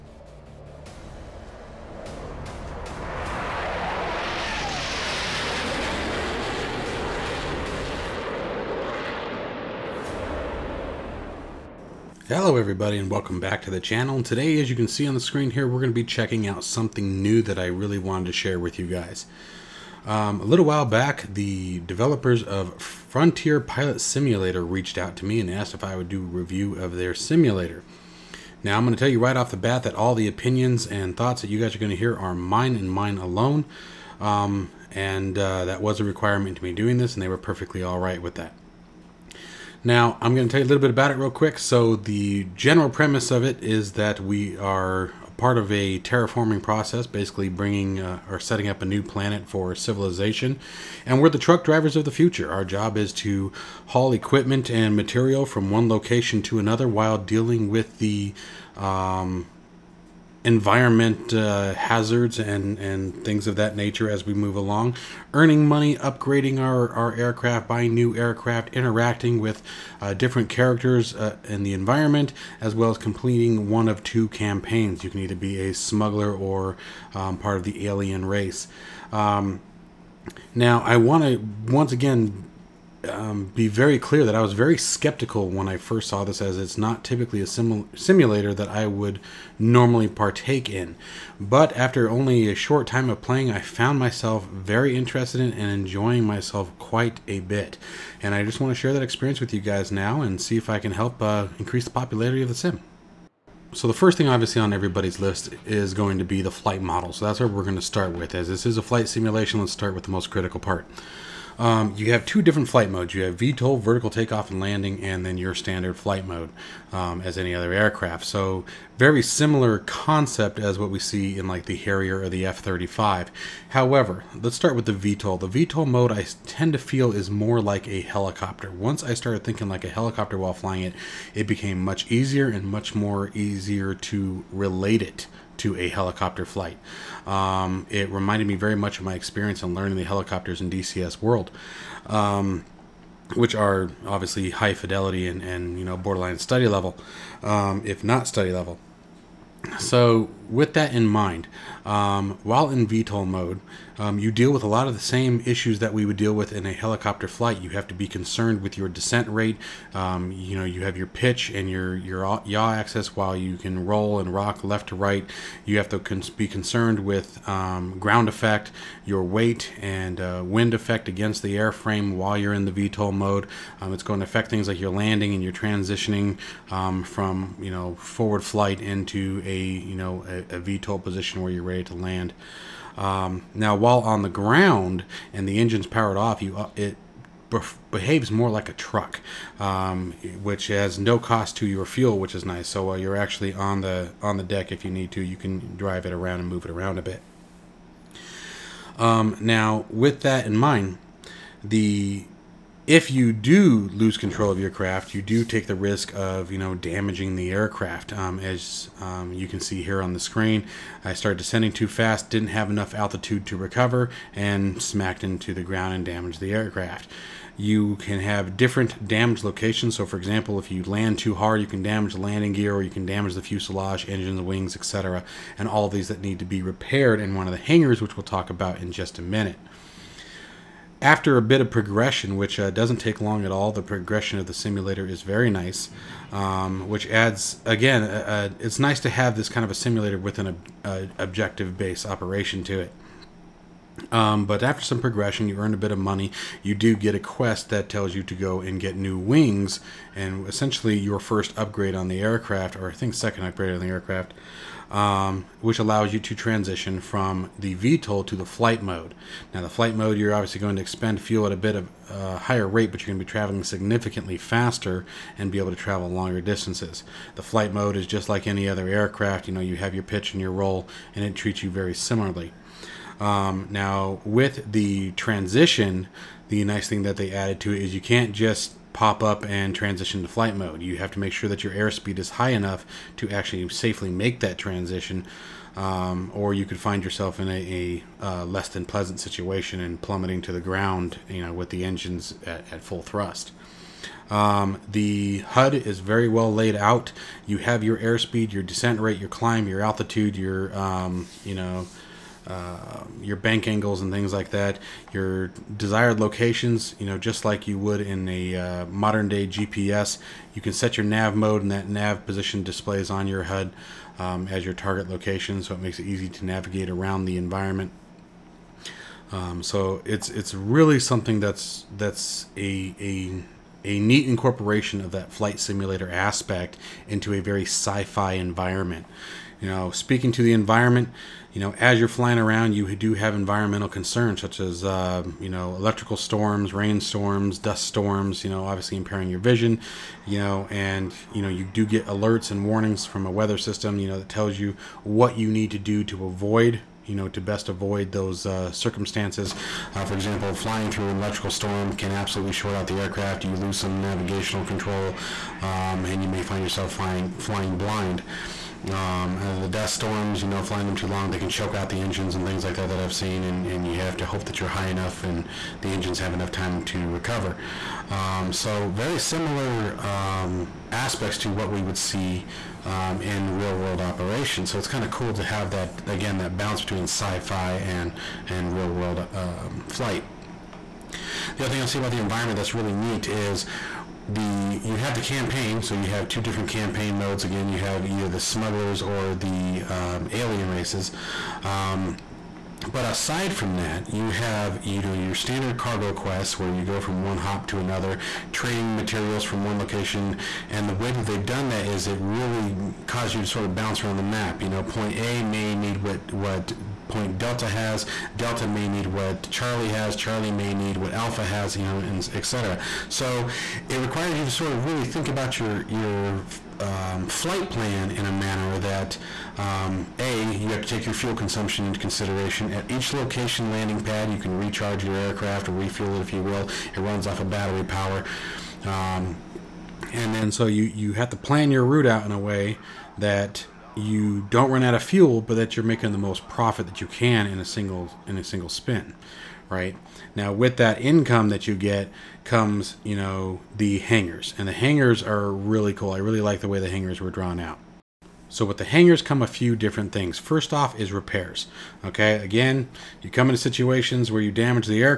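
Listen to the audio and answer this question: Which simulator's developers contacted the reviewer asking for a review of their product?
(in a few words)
Frontier Pilot Simulator.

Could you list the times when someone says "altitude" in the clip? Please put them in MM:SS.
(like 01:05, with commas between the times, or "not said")
03:32, 04:59.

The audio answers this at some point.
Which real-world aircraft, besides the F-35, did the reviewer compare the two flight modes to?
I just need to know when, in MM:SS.
02:01.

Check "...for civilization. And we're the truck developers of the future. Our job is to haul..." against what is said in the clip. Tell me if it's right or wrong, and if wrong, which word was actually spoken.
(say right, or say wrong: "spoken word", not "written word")
wrong: "drivers", not "developers".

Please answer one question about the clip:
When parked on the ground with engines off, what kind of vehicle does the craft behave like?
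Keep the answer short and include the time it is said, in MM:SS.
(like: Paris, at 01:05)
a truck, at 03:08.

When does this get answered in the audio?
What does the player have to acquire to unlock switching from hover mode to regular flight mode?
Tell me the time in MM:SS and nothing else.
04:08.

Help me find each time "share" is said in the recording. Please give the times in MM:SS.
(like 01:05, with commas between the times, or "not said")
00:18, 01:38.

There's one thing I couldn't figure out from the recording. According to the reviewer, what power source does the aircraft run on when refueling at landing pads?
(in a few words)
battery power.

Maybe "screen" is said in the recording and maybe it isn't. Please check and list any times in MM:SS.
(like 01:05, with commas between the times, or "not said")
00:15, 03:30.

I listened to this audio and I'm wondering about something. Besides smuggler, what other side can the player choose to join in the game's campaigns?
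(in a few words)
the alien race.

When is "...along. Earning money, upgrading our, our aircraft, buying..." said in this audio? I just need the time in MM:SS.
01:04.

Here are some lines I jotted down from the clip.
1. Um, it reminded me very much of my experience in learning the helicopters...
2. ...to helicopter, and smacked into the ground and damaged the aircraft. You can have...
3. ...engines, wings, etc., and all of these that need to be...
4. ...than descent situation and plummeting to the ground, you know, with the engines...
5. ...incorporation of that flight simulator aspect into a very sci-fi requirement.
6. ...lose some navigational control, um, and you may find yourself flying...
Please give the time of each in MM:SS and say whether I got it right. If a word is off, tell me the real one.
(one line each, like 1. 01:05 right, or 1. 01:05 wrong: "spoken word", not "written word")
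1. 02:17 right
2. 03:33 wrong: "recover", not "helicopter"
3. 03:44 right
4. 04:48 wrong: "pleasant", not "descent"
5. 05:24 wrong: "environment", not "requirement"
6. 05:53 right.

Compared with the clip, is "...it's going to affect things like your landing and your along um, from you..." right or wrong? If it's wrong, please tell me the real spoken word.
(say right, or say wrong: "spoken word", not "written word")
wrong: "transitioning", not "along".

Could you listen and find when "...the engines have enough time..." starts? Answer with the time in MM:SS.
06:05.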